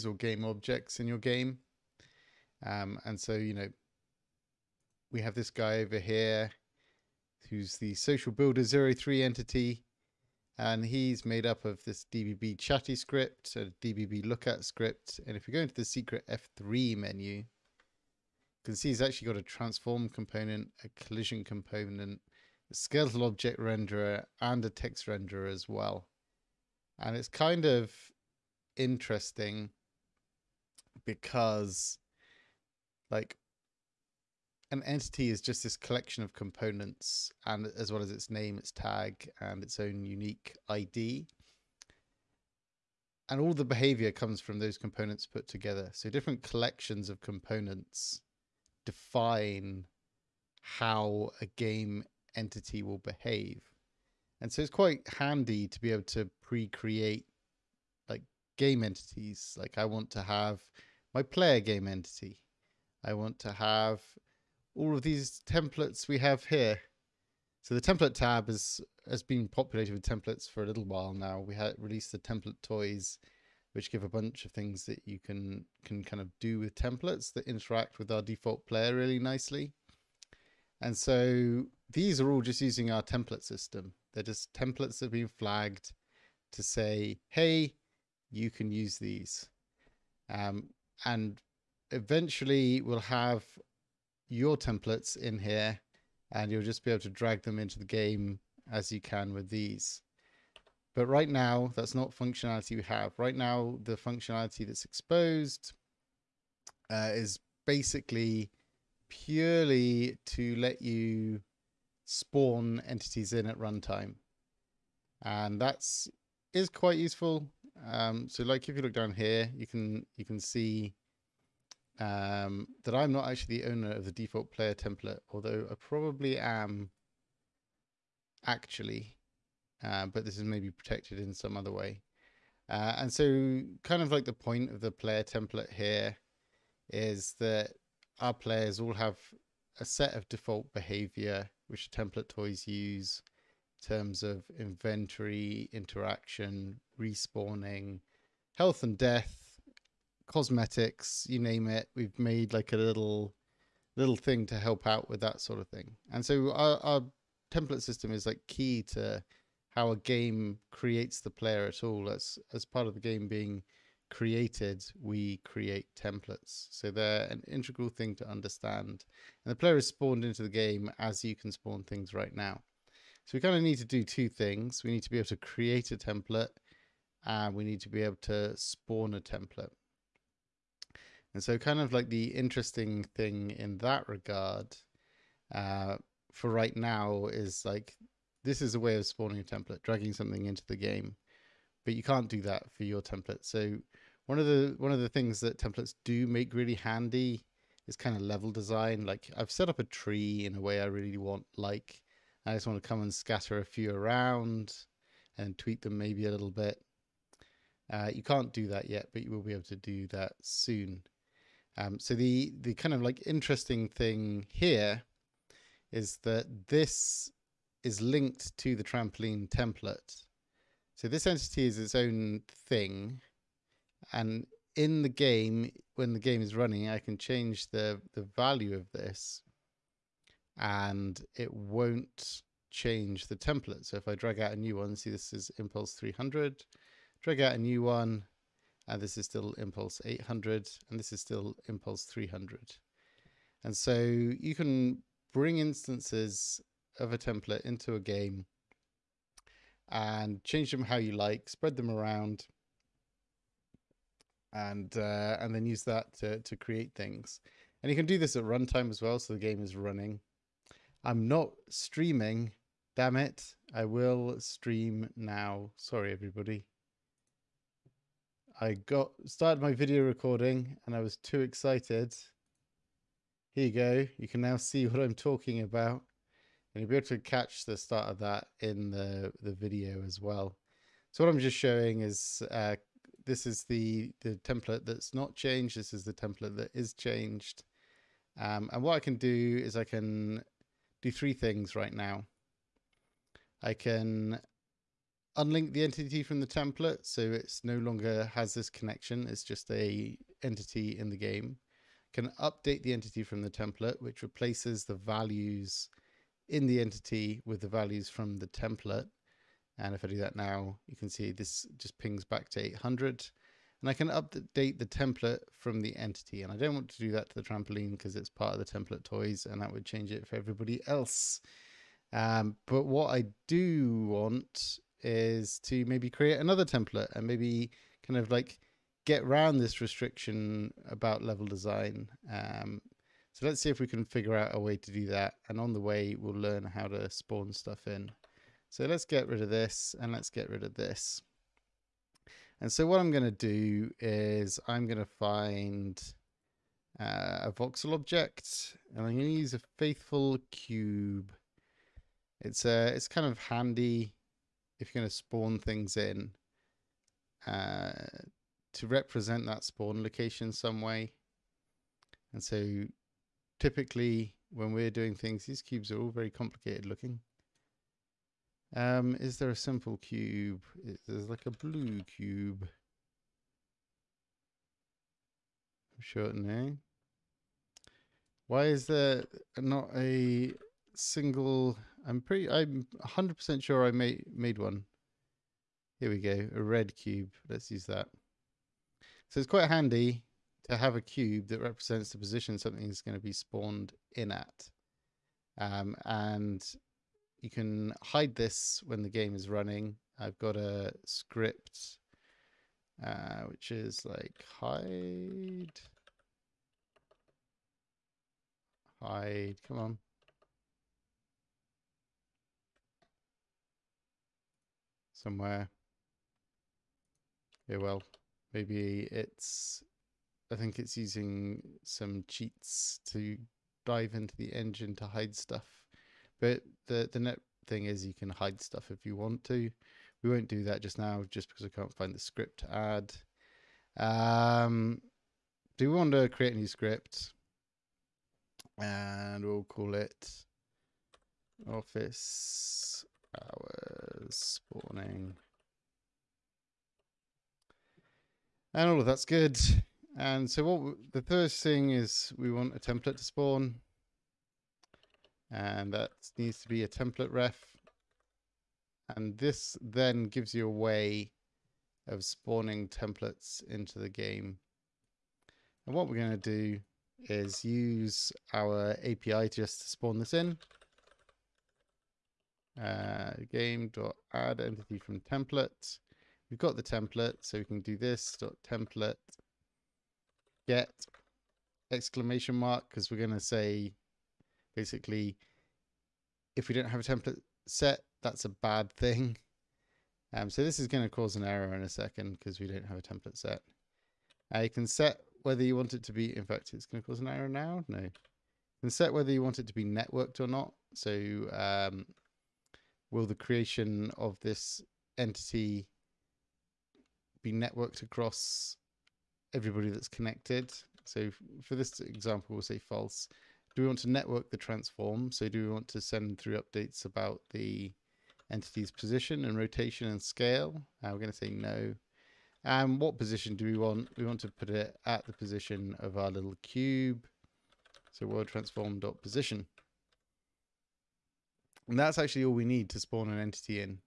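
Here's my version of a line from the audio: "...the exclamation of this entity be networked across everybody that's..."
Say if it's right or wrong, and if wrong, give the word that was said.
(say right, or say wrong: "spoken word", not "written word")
wrong: "creation", not "exclamation".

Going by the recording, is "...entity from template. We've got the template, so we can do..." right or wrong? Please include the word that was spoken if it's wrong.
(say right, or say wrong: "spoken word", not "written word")
right.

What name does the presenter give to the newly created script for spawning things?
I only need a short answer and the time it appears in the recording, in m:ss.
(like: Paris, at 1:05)
office hours spawning, at 7:21.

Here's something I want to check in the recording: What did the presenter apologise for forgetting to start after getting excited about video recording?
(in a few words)
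streaming.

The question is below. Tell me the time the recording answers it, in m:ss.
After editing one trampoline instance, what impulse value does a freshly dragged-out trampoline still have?
3:59.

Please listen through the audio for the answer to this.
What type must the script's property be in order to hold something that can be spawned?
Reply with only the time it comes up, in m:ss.
7:36.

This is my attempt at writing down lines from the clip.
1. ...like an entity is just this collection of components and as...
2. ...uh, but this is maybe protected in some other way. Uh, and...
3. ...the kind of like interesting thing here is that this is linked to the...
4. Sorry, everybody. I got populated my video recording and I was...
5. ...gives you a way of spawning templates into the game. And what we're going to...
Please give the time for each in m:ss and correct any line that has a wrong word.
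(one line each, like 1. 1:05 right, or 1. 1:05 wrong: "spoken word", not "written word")
1. 0:33 right
2. 2:09 right
3. 3:32 right
4. 4:25 wrong: "started", not "populated"
5. 7:40 right.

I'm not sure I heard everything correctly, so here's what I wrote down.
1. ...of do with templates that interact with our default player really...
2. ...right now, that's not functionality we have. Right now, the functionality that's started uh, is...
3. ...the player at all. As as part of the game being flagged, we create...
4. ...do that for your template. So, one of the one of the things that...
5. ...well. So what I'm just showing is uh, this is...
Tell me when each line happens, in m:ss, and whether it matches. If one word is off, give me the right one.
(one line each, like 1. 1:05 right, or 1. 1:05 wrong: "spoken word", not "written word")
1. 1:16 right
2. 1:41 wrong: "exposed", not "started"
3. 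2:41 wrong: "created", not "flagged"
4. 3:12 right
5. 4:40 right.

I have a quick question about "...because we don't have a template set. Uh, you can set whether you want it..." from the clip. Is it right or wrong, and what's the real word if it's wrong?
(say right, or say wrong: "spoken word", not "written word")
right.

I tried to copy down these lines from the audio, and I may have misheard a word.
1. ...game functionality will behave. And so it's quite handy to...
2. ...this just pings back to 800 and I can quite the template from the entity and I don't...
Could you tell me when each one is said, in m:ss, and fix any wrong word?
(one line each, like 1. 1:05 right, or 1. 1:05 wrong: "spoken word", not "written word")
1. 0:51 wrong: "entity", not "functionality"
2. 5:11 wrong: "update", not "quite".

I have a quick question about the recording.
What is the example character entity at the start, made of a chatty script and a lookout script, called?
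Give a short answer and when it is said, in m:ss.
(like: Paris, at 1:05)
Social Builder 03, at 0:07.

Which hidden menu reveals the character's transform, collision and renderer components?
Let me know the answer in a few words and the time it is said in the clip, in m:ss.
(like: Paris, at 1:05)
F3 menu, at 0:16.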